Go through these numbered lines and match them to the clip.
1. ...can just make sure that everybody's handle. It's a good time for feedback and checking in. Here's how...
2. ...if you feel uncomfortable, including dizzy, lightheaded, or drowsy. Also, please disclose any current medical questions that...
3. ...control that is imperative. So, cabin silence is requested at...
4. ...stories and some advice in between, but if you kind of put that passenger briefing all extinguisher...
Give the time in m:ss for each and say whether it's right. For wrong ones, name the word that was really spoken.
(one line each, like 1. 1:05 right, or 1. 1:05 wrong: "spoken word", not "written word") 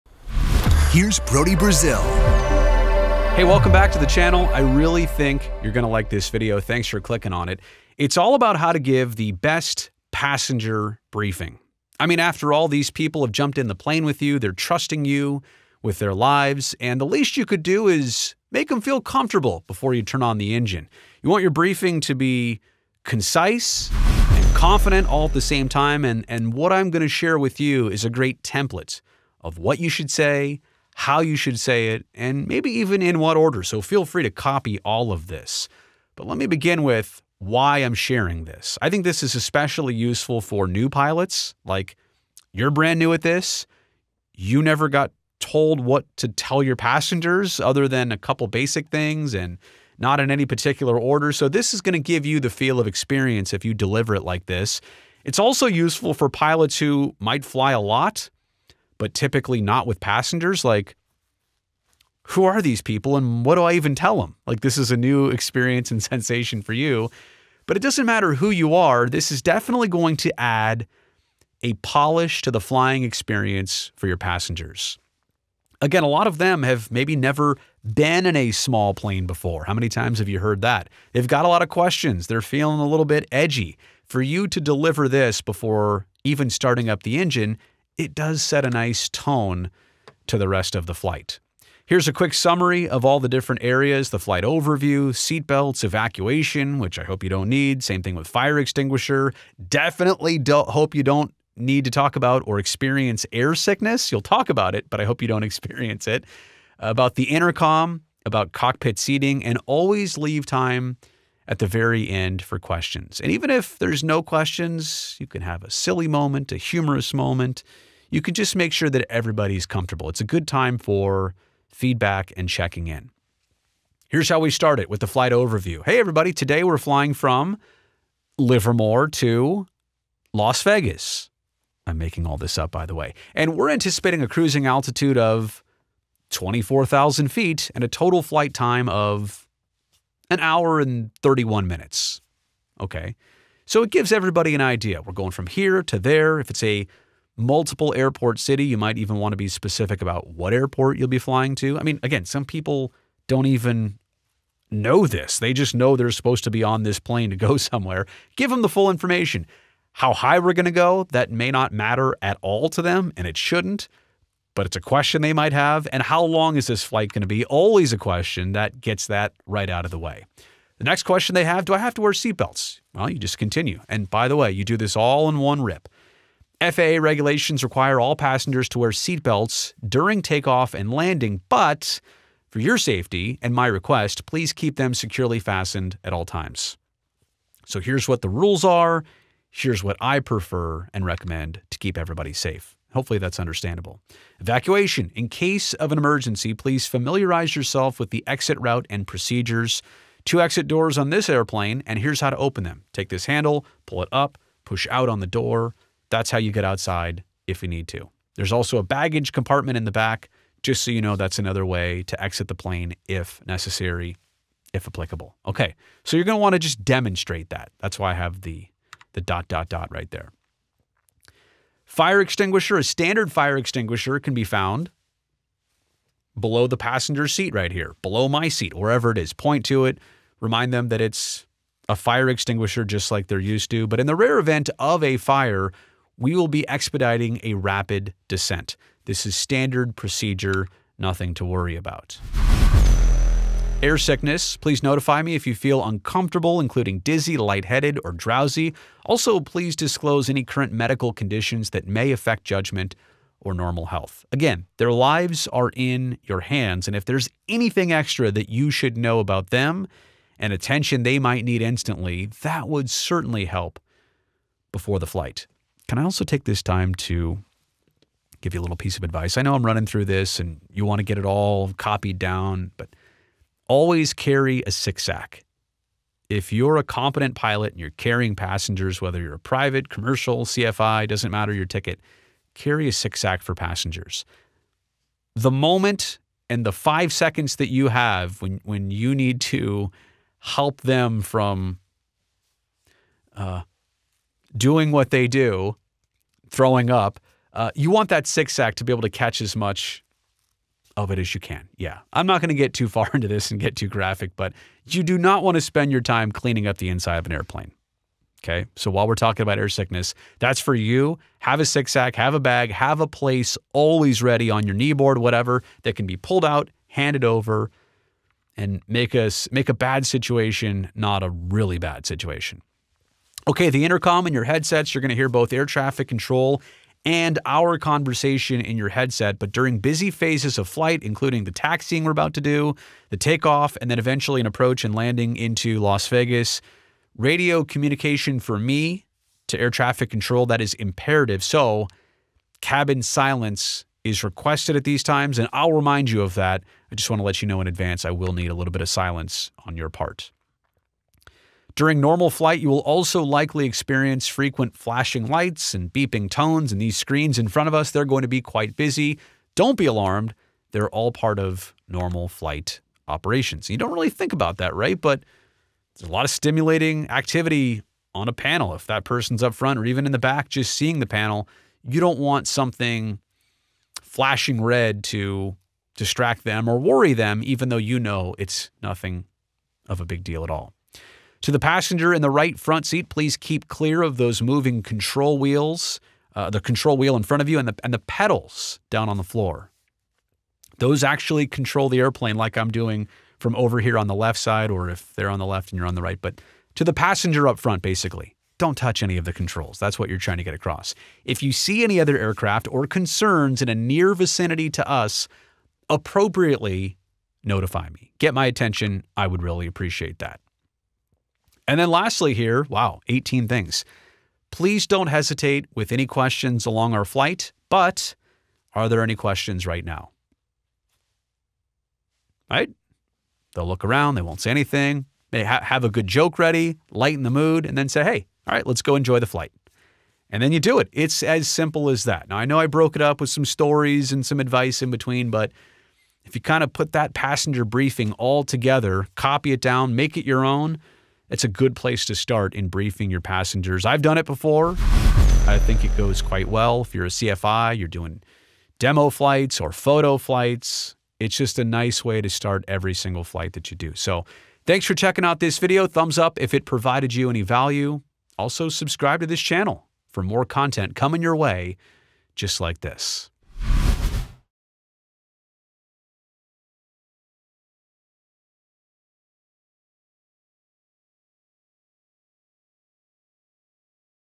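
1. 1:58 wrong: "comfortable", not "handle"
2. 4:05 wrong: "conditions", not "questions"
3. 5:40 right
4. 7:13 wrong: "together", not "extinguisher".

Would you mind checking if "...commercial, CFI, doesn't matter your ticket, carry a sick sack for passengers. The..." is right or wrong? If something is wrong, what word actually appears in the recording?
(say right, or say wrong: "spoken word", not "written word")
right.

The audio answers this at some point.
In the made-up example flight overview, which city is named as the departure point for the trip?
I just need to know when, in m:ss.
2:08.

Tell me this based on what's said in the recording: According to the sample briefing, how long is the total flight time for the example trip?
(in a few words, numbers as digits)
1 hour 31 minutes.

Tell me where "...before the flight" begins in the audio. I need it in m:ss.
4:24.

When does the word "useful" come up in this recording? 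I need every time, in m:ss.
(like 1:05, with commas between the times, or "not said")
0:39, 0:55.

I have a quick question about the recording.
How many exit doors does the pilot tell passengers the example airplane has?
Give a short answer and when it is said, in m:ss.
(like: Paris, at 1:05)
2, at 3:20.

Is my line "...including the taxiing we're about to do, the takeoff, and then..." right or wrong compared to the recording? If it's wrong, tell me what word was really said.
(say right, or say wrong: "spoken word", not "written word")
right.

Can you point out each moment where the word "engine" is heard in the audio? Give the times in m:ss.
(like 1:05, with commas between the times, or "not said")
0:20, 1:27.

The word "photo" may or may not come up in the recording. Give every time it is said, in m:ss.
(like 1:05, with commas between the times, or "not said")
7:29.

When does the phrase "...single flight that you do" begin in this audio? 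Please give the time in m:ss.
7:32.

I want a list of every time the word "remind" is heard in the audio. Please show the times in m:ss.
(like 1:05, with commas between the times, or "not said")
3:50, 5:45.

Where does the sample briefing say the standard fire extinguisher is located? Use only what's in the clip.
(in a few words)
below the passenger seat.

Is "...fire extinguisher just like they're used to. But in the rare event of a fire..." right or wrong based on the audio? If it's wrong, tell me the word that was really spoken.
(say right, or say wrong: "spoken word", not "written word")
right.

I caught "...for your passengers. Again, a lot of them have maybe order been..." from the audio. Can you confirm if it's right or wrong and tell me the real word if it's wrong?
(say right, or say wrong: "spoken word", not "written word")
wrong: "never", not "order".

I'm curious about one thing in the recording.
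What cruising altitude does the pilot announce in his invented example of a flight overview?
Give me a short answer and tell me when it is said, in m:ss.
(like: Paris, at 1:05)
24,000 feet, at 2:16.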